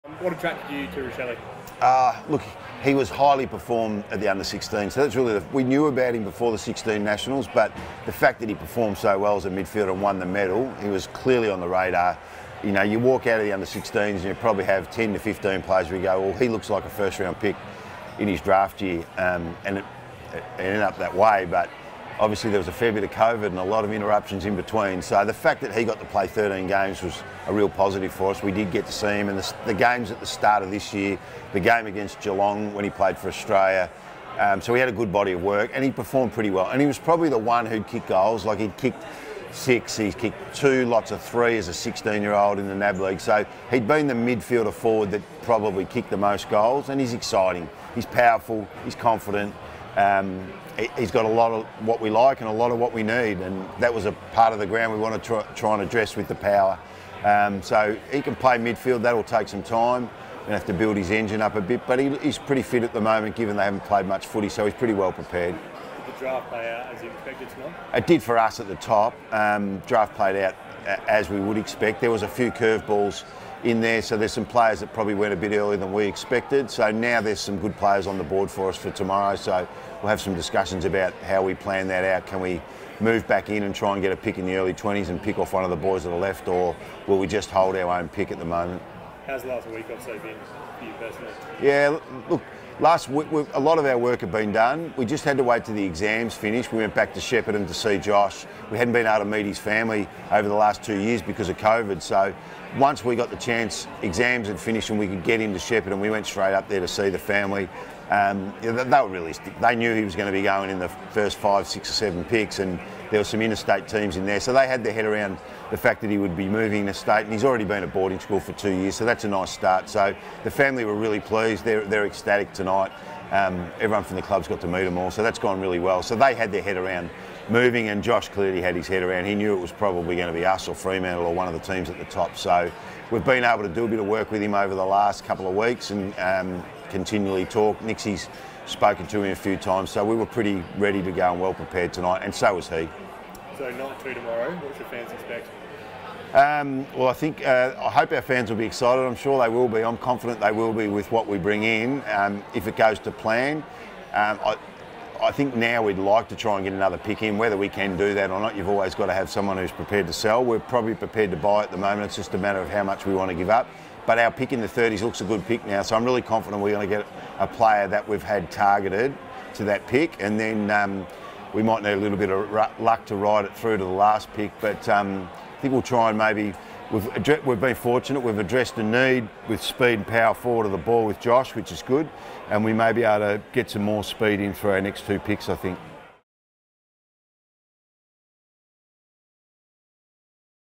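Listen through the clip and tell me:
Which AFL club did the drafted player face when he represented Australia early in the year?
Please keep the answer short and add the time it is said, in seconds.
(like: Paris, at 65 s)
Geelong, at 32 s.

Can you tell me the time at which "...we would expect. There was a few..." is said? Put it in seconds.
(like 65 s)
71 s.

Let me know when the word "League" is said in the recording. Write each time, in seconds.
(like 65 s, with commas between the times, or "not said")
42 s.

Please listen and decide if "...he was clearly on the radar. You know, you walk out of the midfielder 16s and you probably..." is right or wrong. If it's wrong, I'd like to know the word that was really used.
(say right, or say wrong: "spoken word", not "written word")
wrong: "under", not "midfielder".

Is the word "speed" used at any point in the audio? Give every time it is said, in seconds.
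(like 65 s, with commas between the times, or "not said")
179 s, 184 s.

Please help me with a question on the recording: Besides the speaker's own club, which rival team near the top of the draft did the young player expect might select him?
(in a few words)
Fremantle.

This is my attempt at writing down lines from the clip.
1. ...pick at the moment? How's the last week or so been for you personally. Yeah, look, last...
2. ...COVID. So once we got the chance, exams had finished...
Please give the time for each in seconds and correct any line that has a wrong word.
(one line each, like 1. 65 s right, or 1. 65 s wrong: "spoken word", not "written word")
1. 88 s right
2. 101 s right.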